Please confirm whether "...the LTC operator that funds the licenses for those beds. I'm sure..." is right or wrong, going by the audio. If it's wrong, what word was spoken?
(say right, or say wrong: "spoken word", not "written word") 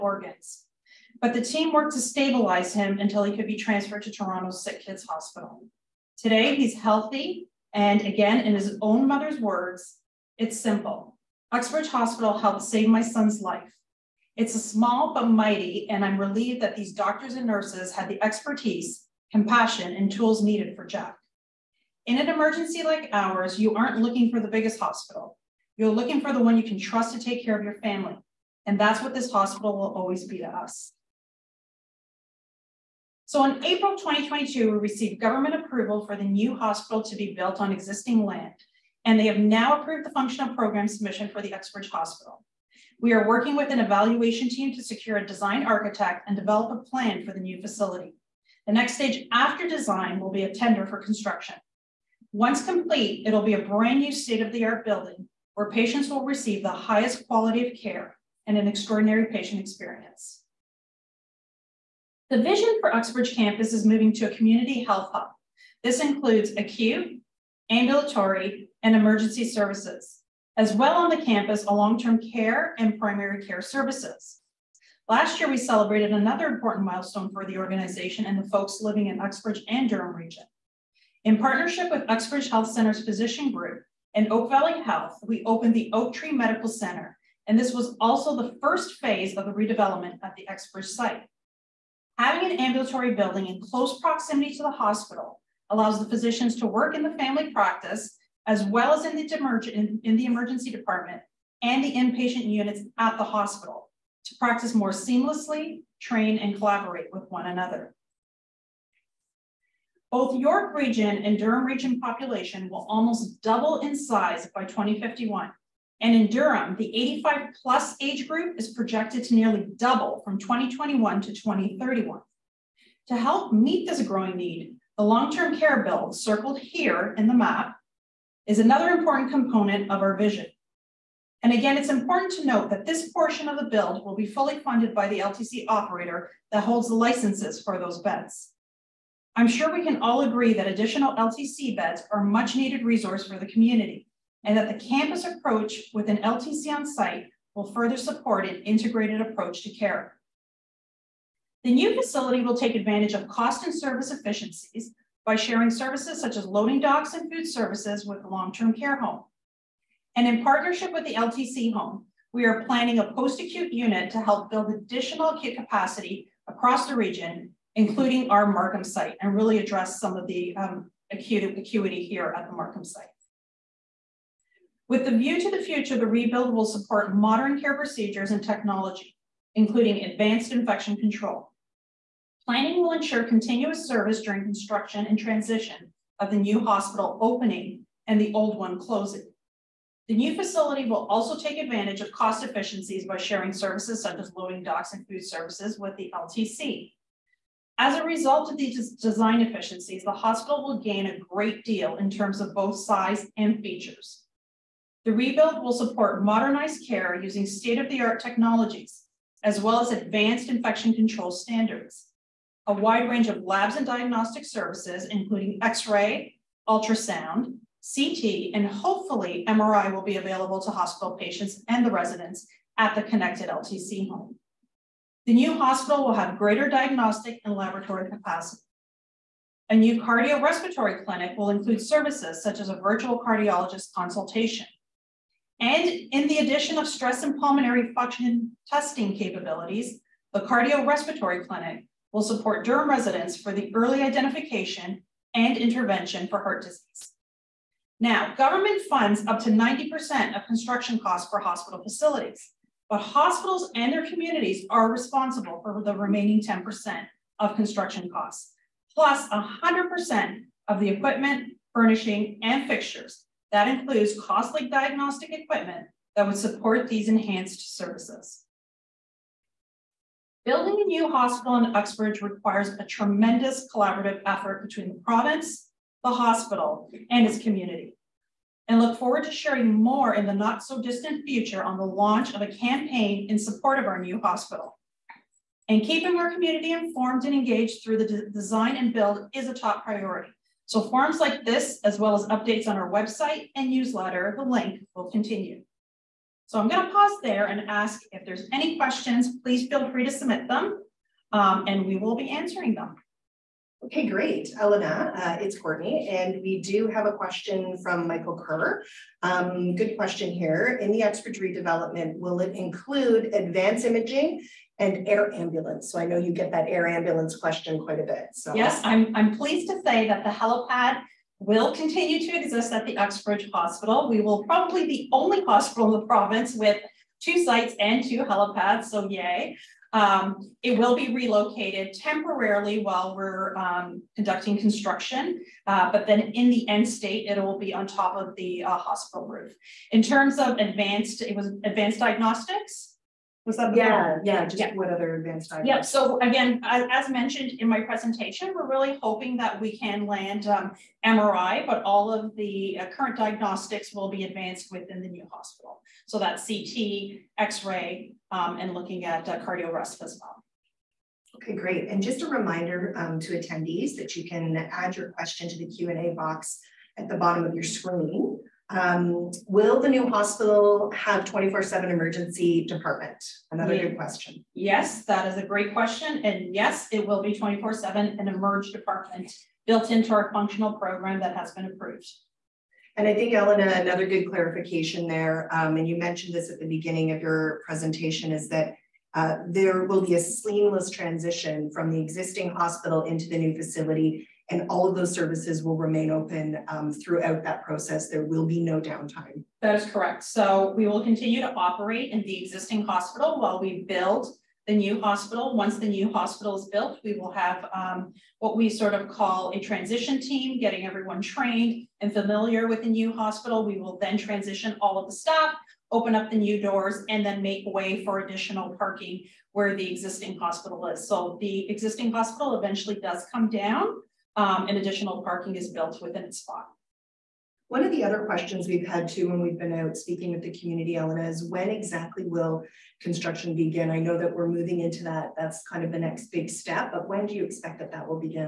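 wrong: "holds", not "funds".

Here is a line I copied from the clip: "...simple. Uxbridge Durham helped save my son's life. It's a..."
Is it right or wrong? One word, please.
wrong.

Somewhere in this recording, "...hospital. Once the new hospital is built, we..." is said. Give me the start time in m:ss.
6:44.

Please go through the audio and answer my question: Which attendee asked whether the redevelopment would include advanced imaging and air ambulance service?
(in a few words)
Michael Kerr.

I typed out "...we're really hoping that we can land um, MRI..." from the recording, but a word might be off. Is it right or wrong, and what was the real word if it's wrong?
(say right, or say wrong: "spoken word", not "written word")
right.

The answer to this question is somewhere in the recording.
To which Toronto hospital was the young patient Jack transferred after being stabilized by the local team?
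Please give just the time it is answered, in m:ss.
0:04.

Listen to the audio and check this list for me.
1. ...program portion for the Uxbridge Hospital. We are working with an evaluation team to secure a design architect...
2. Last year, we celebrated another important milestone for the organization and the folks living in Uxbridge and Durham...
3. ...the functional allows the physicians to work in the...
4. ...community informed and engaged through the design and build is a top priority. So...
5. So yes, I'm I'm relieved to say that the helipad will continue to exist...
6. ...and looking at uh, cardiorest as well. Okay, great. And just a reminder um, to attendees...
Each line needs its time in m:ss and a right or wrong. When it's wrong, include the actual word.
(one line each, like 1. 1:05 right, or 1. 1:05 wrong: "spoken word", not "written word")
1. 0:40 wrong: "submission", not "portion"
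2. 1:15 right
3. 1:34 wrong: "hospital", not "functional"
4. 4:46 right
5. 5:18 wrong: "pleased", not "relieved"
6. 5:58 right.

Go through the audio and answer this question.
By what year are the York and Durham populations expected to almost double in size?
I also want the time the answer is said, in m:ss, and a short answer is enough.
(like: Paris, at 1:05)
2051, at 1:54.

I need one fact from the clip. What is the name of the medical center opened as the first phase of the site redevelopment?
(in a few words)
Oak Tree Medical Center.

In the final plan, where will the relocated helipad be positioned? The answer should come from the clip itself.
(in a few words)
hospital roof.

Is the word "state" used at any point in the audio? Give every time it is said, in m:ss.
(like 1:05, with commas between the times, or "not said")
0:54, 3:27, 5:36.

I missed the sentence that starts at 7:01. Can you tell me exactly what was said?
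So the existing hospital eventually does come down um, and additional parking is built within its spot.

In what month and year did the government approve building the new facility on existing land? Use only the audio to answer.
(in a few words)
April 2022.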